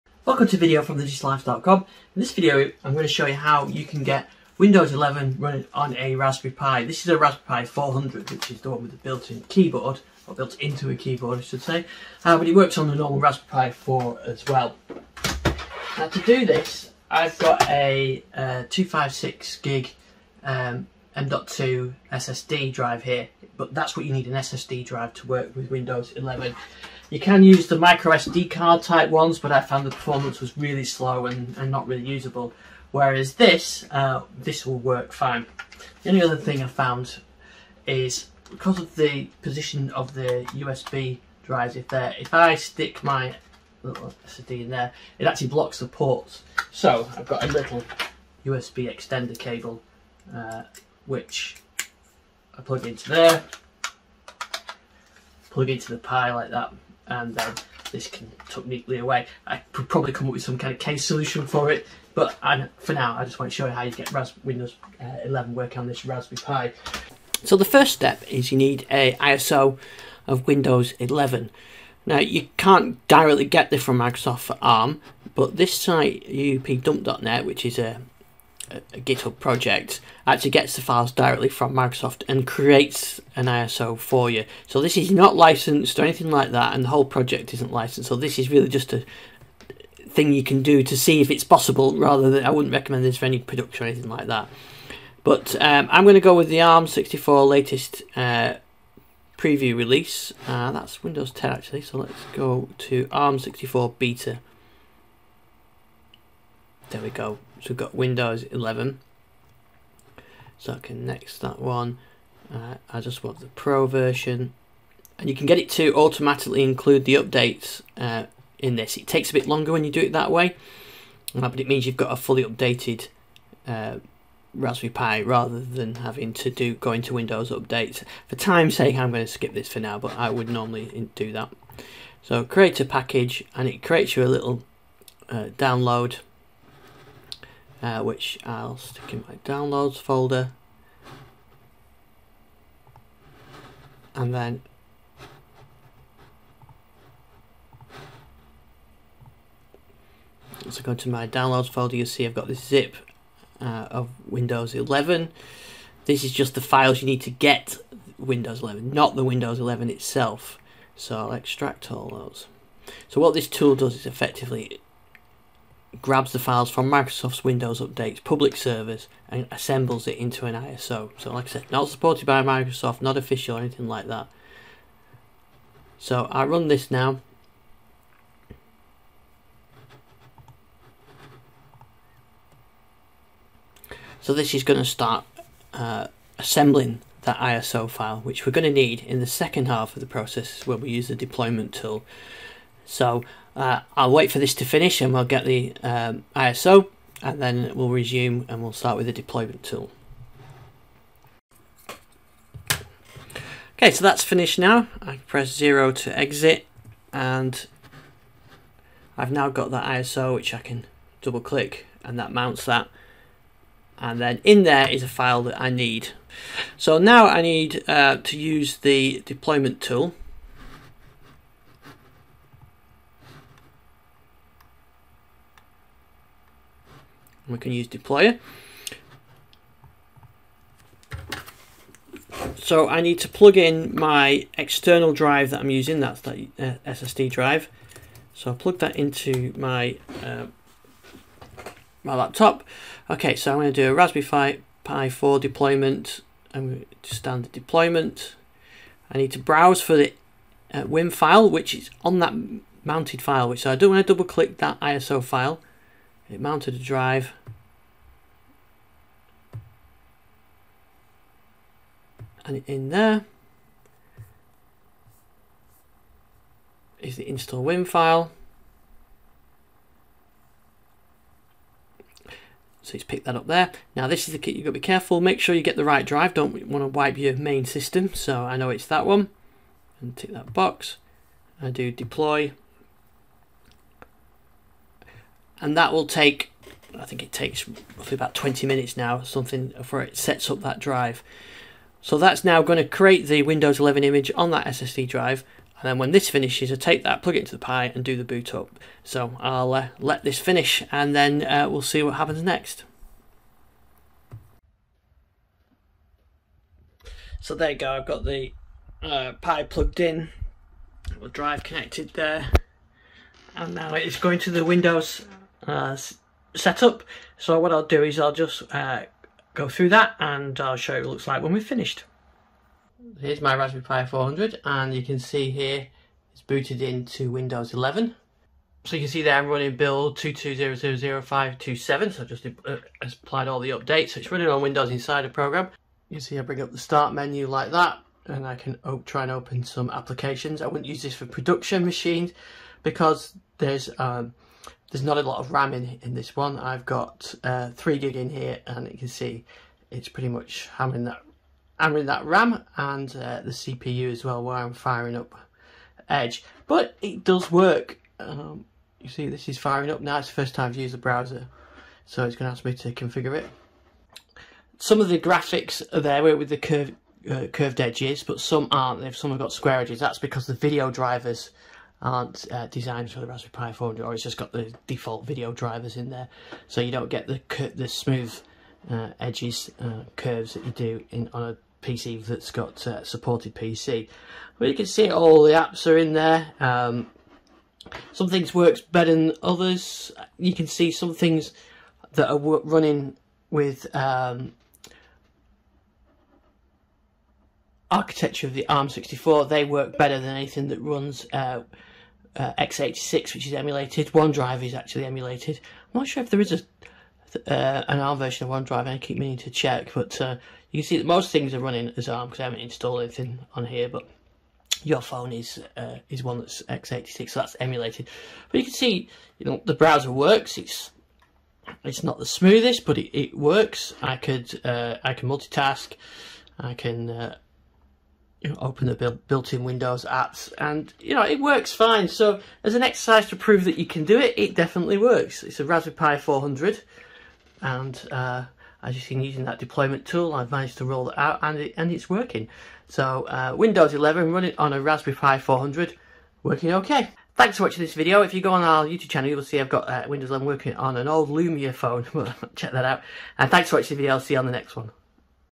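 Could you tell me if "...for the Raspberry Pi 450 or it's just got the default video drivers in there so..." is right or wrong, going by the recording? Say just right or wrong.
wrong.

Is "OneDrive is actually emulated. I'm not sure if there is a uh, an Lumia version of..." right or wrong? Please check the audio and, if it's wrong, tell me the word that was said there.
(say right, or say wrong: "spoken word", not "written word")
wrong: "ARM", not "Lumia".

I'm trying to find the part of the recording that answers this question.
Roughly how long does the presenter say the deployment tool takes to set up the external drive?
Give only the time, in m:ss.
4:48.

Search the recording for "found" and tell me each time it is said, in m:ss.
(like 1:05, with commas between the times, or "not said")
0:29, 0:36.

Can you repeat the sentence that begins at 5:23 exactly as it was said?
Here's my Raspberry Pi 400 and you can see here it's booted into Windows 11.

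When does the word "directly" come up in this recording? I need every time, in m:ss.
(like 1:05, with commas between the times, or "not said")
1:13, 1:21.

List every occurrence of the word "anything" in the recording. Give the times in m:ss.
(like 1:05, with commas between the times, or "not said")
1:26, 1:33, 2:53, 6:40, 6:53.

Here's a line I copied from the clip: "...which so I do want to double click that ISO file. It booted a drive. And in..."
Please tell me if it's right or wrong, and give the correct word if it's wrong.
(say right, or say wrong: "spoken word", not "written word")
wrong: "mounted", not "booted".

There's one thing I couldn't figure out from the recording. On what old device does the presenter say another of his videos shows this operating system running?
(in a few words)
Lumia phone.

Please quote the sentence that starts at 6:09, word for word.
If some have got square edges.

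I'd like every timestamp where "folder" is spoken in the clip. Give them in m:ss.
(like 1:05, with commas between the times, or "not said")
2:19, 2:31.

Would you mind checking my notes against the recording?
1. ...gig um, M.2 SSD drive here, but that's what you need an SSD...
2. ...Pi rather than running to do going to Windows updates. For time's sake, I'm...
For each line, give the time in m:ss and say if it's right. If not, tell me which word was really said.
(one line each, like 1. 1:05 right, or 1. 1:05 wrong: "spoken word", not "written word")
1. 0:19 right
2. 2:04 wrong: "having", not "running".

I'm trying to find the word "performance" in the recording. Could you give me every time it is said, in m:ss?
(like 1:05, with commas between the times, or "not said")
0:29.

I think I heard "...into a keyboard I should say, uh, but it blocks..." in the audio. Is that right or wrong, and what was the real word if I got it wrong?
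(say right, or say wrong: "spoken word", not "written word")
wrong: "works", not "blocks".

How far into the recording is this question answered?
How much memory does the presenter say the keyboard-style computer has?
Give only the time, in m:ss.
5:47.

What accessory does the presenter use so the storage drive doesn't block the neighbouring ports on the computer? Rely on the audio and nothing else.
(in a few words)
USB extender cable.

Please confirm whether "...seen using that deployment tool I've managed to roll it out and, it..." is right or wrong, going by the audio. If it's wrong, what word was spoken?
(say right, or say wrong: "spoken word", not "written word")
right.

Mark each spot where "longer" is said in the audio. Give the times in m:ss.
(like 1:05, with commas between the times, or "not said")
1:59.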